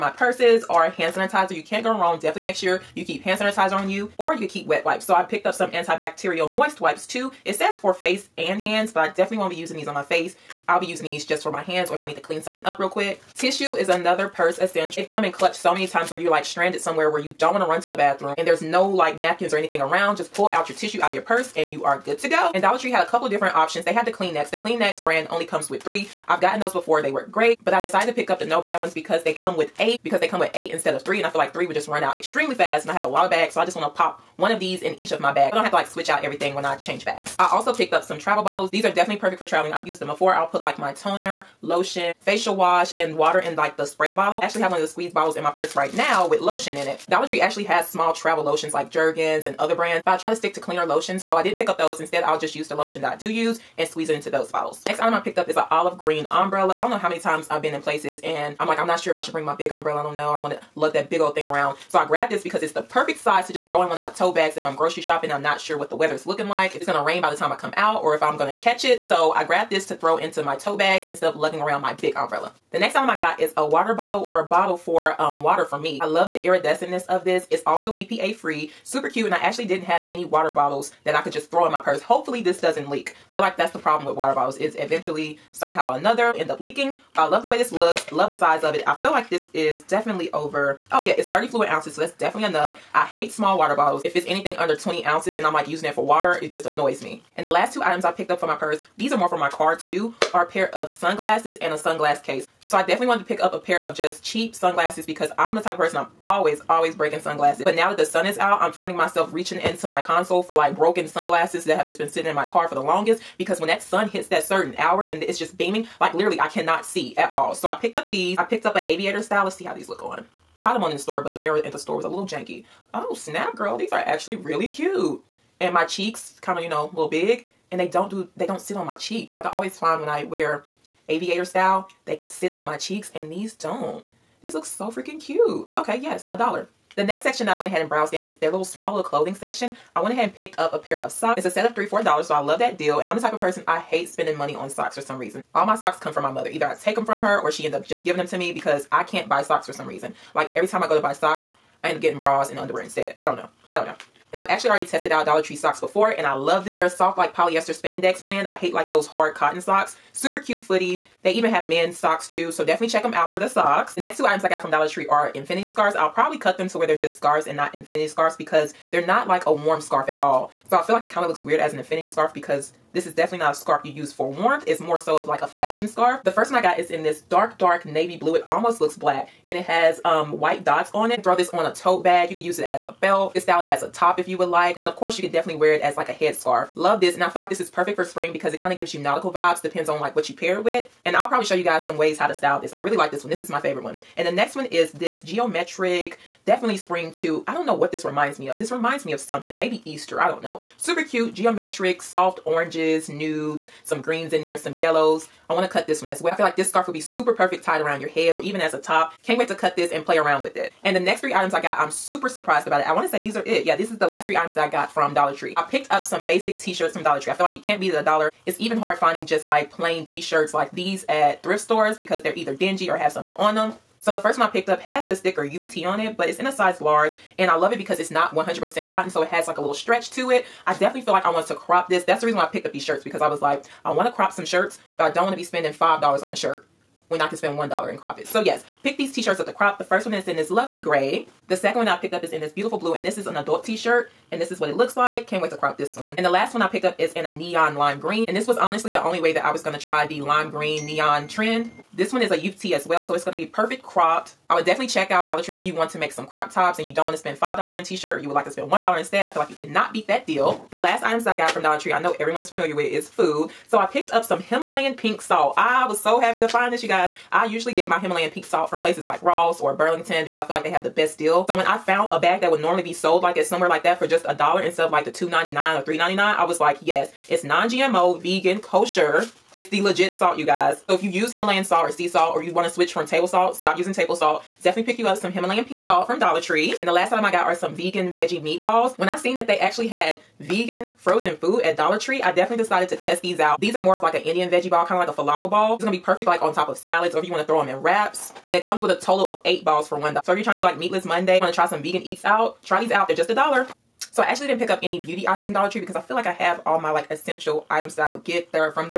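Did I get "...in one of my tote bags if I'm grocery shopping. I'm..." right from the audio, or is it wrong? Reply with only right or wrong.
right.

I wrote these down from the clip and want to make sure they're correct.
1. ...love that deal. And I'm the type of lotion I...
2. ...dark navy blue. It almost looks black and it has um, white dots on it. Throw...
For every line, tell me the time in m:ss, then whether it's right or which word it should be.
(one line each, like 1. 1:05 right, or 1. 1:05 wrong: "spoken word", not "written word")
1. 2:22 wrong: "person", not "lotion"
2. 2:57 right.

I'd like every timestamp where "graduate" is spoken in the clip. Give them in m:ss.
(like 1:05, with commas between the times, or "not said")
not said.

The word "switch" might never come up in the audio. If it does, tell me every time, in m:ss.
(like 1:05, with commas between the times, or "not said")
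0:35, 4:42.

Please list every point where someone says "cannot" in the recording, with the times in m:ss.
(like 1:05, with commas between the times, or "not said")
1:56, 4:19.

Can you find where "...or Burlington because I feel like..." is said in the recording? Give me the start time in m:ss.
4:29.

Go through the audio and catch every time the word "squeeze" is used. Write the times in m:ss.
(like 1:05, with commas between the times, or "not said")
0:44, 0:53.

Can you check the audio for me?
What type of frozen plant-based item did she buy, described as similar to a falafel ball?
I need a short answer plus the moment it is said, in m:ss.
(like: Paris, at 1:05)
vegan veggie meatballs, at 4:47.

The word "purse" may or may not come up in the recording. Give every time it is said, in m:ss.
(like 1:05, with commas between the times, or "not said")
0:00, 0:14, 0:21, 0:45, 1:21, 1:38.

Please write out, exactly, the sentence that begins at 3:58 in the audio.
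So yes, pick these t-shirts up to crop.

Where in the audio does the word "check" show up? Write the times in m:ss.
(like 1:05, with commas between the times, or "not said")
2:42, 4:14.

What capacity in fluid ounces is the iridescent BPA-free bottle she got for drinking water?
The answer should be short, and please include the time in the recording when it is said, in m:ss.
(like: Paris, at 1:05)
30, at 1:31.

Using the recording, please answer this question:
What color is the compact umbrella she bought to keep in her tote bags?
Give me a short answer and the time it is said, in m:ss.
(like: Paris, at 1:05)
olive green, at 0:55.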